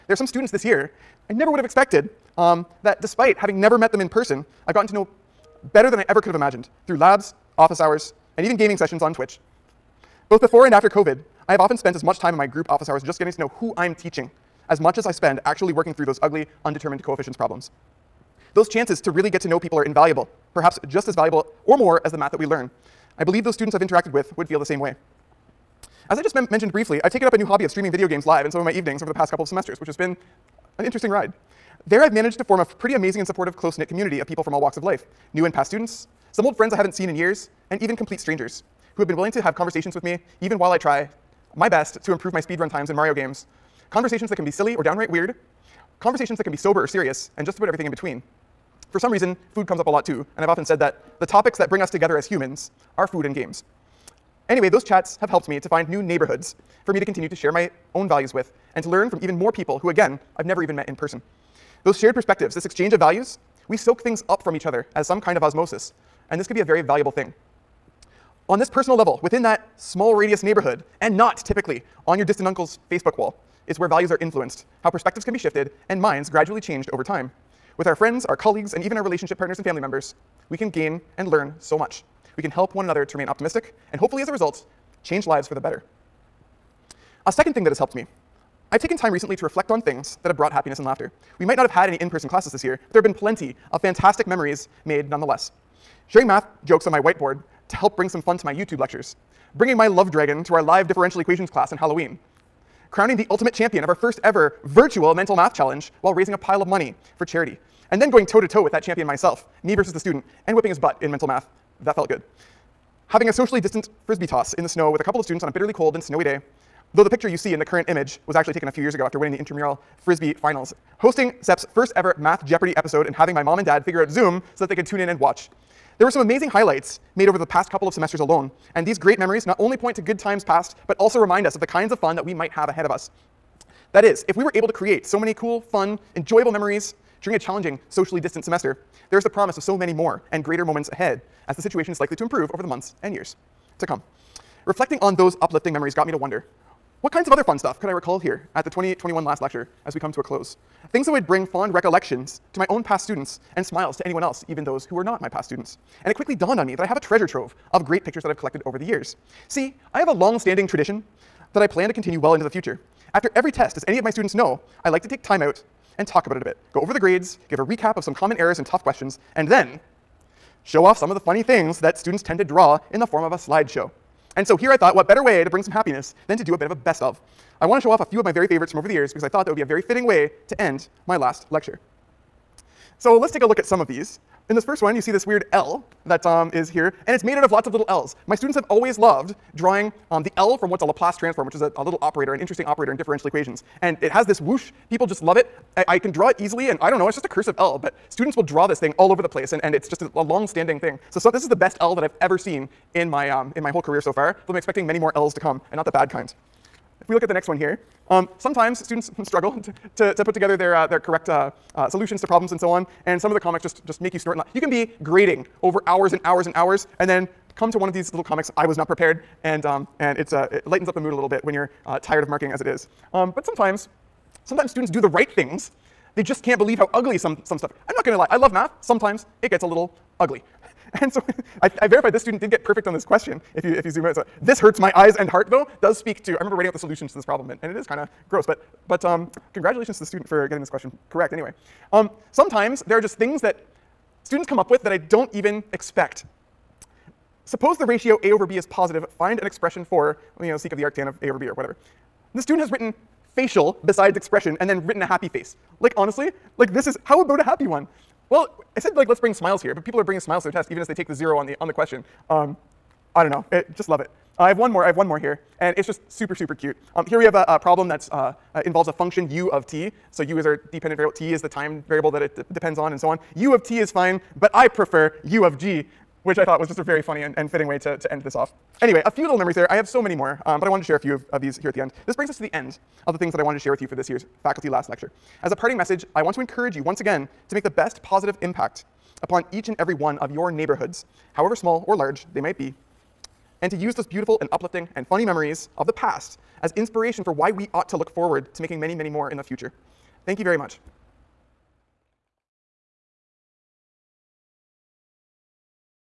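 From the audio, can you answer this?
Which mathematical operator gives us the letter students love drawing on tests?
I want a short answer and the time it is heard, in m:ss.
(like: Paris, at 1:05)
Laplace transform, at 3:10.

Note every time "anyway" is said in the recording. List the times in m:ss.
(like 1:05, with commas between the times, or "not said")
0:54, 4:01, 4:38.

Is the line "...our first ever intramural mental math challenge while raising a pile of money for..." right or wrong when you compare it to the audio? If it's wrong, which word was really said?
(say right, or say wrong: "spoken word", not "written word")
wrong: "virtual", not "intramural".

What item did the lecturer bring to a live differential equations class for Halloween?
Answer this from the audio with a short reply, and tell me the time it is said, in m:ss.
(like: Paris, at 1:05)
love dragon, at 1:39.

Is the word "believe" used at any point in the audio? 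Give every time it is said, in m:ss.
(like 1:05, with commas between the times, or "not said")
0:23, 3:46.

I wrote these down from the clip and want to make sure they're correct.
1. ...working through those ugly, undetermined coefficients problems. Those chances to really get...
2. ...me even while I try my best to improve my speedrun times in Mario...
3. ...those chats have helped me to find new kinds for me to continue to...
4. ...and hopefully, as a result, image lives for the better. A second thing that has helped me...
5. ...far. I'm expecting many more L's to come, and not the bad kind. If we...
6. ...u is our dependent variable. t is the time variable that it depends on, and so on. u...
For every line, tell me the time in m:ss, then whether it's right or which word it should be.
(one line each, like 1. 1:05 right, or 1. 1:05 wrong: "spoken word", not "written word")
1. 0:15 right
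2. 0:40 right
3. 0:54 wrong: "neighborhoods", not "kinds"
4. 1:23 wrong: "change", not "image"
5. 3:24 right
6. 4:30 right.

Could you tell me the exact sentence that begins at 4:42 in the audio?
This brings us to the end of the things that I wanted to share with you for this year's Faculty Last Lecture.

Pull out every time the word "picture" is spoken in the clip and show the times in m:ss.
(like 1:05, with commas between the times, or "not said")
1:57, 2:38.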